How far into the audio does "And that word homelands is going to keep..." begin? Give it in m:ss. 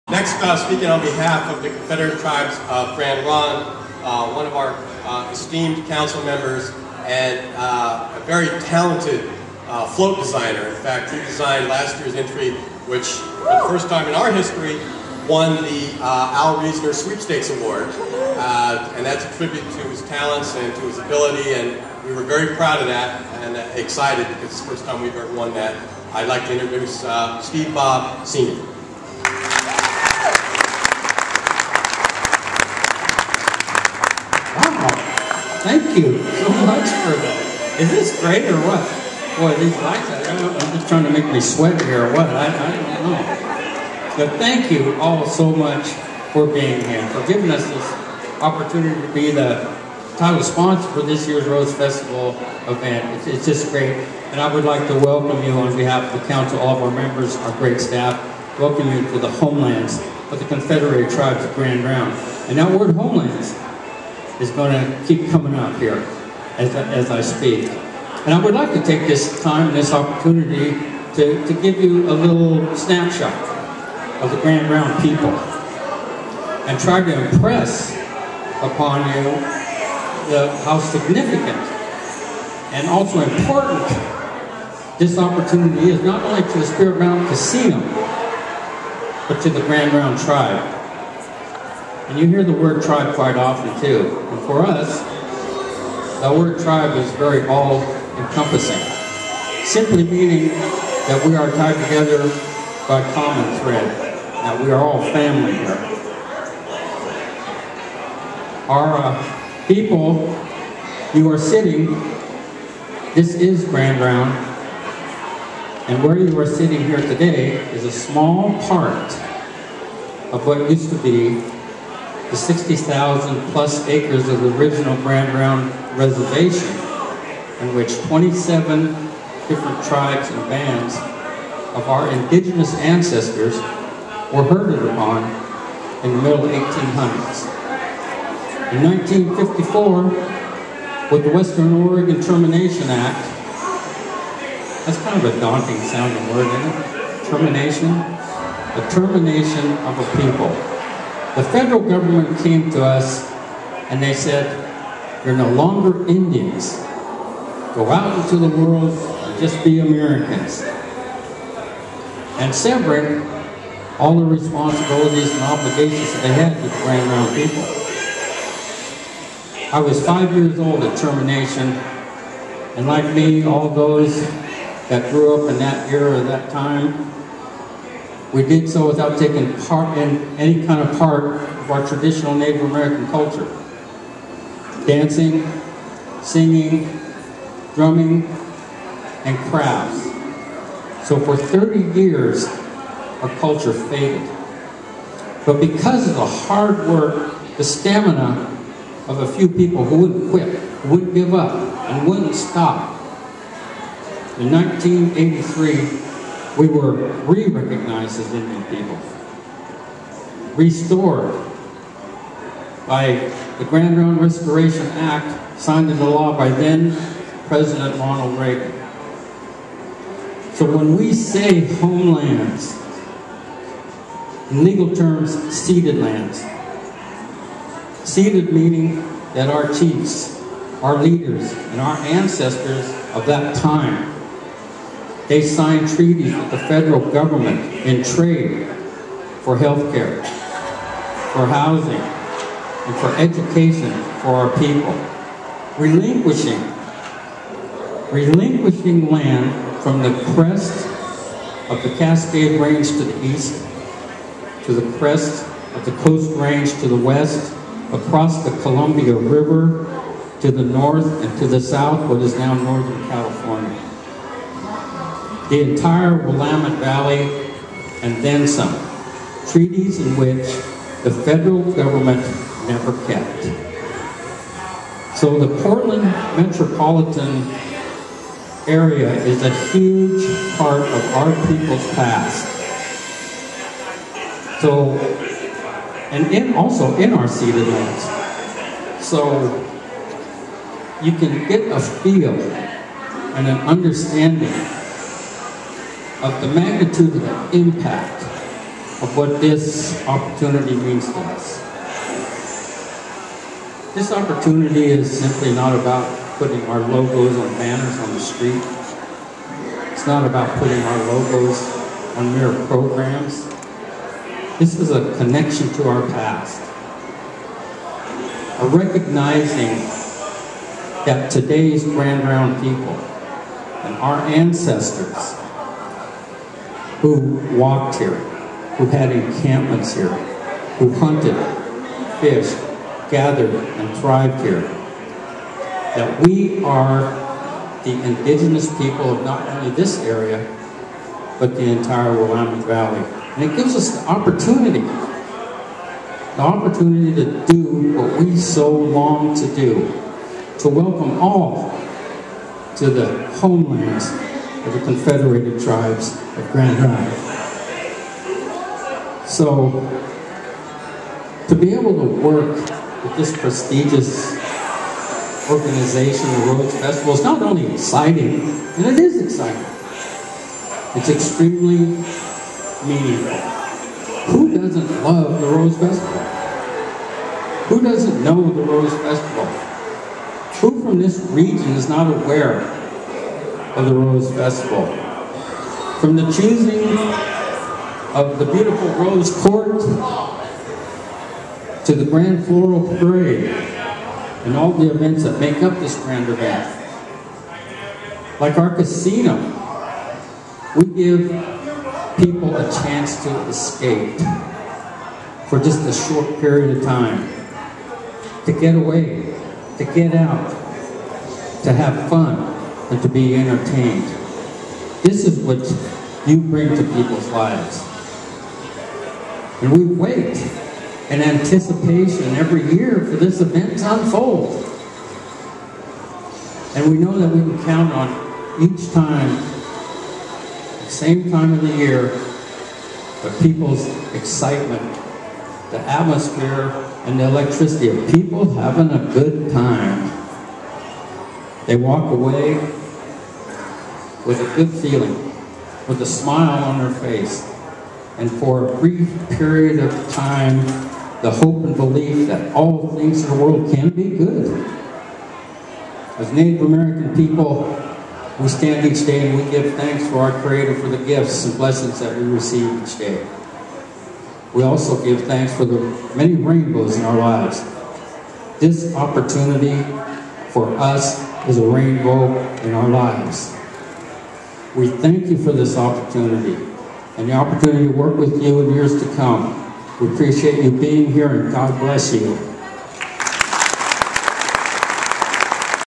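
1:02.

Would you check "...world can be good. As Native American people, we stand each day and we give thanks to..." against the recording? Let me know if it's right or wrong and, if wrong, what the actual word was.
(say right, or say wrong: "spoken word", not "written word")
right.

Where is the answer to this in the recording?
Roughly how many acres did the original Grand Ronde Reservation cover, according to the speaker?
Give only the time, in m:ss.
2:02.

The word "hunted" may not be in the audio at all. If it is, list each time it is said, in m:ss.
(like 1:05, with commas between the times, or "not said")
5:30.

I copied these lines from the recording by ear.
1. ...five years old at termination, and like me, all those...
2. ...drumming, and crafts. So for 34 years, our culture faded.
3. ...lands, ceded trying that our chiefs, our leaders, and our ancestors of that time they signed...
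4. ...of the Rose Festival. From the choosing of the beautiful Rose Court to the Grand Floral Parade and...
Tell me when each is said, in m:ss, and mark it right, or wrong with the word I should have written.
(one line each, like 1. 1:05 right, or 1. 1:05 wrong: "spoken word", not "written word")
1. 2:50 right
2. 3:07 wrong: "30", not "34"
3. 3:45 wrong: "meaning", not "trying"
4. 6:23 right.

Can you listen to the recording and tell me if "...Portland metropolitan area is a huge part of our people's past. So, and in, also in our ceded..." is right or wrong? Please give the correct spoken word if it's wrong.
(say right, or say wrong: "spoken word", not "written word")
right.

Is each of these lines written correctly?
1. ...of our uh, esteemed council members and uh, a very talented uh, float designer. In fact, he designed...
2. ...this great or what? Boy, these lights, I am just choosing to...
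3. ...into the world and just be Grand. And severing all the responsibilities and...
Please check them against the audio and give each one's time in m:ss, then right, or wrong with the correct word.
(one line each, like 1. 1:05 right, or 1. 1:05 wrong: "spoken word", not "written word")
1. 0:04 right
2. 0:37 wrong: "trying", not "choosing"
3. 2:38 wrong: "Americans", not "Grand".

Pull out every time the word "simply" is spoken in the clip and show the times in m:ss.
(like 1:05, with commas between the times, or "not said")
1:39, 5:05.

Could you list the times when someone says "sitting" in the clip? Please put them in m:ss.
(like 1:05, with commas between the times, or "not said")
1:51, 1:56.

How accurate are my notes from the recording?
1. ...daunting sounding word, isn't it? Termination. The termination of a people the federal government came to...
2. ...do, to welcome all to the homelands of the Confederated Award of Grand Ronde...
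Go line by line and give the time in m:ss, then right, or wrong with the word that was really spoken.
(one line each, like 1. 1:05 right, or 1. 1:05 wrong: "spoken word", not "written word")
1. 2:25 right
2. 5:49 wrong: "Tribes", not "Award".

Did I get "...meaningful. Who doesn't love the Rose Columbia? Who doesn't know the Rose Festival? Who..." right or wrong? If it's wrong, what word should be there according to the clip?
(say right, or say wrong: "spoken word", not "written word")
wrong: "Festival", not "Columbia".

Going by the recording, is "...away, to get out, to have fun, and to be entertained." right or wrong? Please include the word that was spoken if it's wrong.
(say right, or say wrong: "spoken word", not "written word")
right.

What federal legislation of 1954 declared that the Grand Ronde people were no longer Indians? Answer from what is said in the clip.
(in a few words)
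Western Oregon Termination Act.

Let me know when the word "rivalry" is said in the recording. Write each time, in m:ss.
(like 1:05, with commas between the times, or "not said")
not said.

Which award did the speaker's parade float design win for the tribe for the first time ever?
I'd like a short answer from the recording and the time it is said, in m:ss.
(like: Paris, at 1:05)
Al Reisner Sweepstakes Award, at 0:16.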